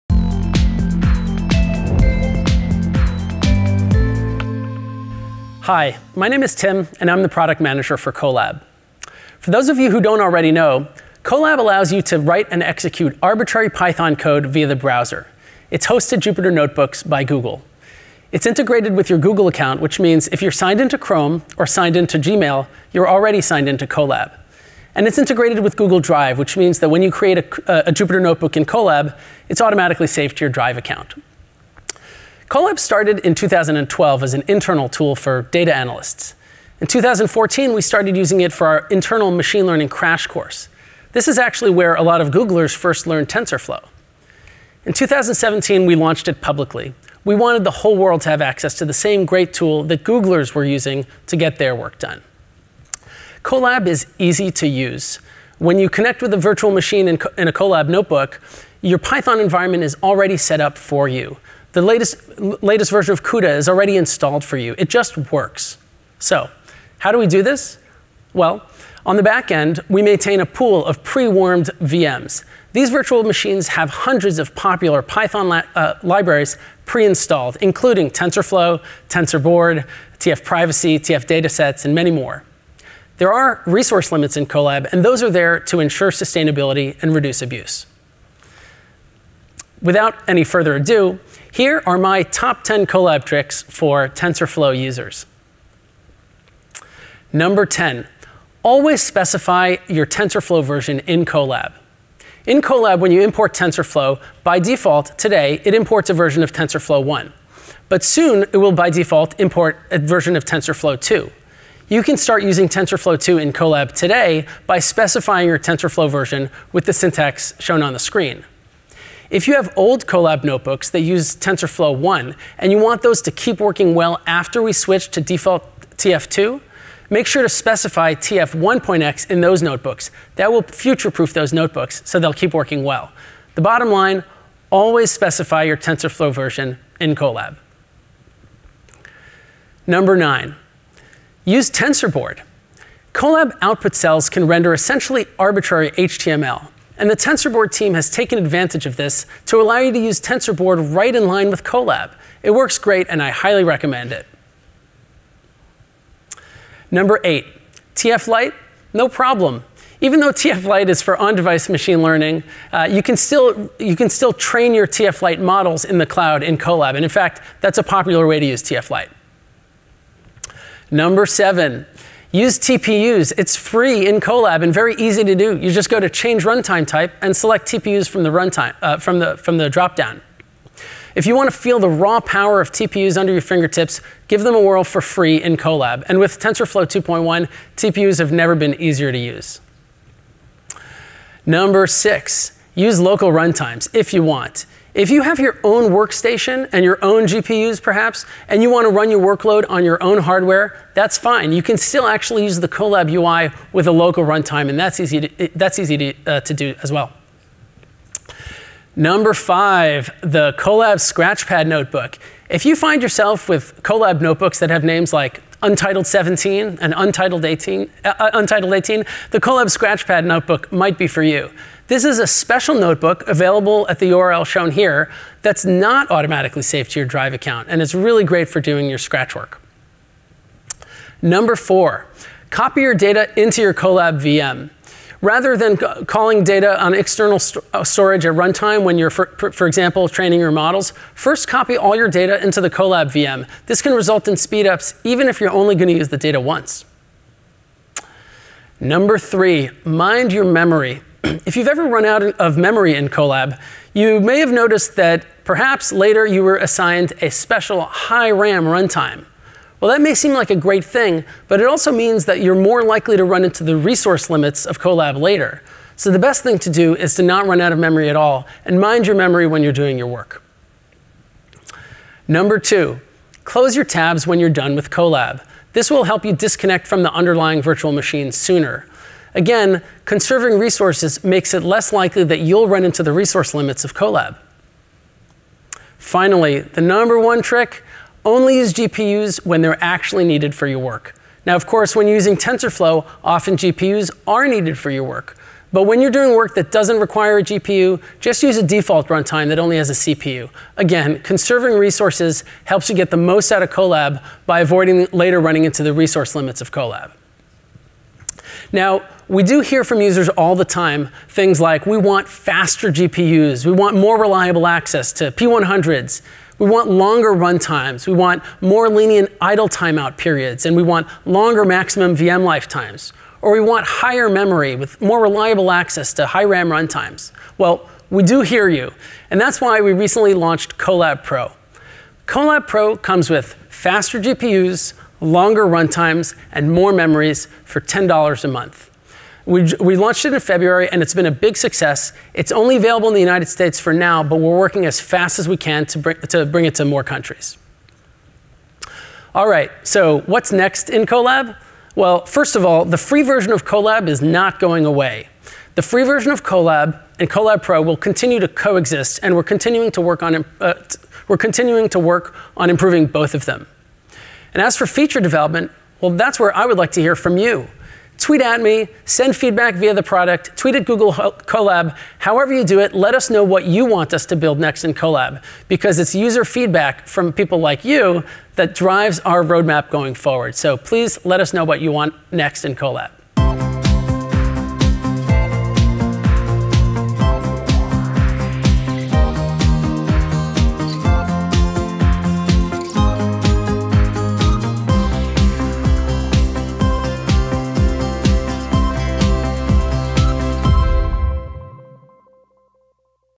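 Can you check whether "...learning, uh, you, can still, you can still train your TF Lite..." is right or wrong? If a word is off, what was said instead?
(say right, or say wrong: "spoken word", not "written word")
right.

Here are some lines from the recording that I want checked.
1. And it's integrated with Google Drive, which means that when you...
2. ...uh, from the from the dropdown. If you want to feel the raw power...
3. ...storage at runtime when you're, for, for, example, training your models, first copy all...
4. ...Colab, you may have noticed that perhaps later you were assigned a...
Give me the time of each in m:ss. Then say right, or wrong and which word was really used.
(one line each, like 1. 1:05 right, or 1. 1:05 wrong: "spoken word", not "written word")
1. 0:24 right
2. 2:58 right
3. 3:57 right
4. 4:13 right.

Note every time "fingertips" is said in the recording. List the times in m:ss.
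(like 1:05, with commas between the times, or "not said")
3:03.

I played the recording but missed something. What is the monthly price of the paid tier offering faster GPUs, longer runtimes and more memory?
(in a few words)
$10.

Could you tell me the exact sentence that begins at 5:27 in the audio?
Well, we do hear you, and that's why we recently launched Colab Pro.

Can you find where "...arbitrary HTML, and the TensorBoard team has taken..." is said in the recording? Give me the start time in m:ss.
2:25.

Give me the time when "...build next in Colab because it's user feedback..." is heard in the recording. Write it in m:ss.
6:14.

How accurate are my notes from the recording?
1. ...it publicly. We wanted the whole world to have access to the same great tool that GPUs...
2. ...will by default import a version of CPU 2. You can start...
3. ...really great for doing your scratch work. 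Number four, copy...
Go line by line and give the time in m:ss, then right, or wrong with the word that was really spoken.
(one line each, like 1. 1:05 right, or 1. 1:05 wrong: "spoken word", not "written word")
1. 0:46 wrong: "Googlers", not "GPUs"
2. 1:48 wrong: "TensorFlow", not "CPU"
3. 3:47 right.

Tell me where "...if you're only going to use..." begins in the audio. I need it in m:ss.
4:05.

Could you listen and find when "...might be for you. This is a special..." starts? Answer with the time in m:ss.
3:40.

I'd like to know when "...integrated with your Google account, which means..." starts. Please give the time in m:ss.
0:18.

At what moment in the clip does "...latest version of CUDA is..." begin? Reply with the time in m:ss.
1:02.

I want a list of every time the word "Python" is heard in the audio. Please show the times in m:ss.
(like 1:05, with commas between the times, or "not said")
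0:13, 0:58, 1:15.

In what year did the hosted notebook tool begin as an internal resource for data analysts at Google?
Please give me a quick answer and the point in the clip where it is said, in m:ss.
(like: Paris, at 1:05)
2012, at 0:33.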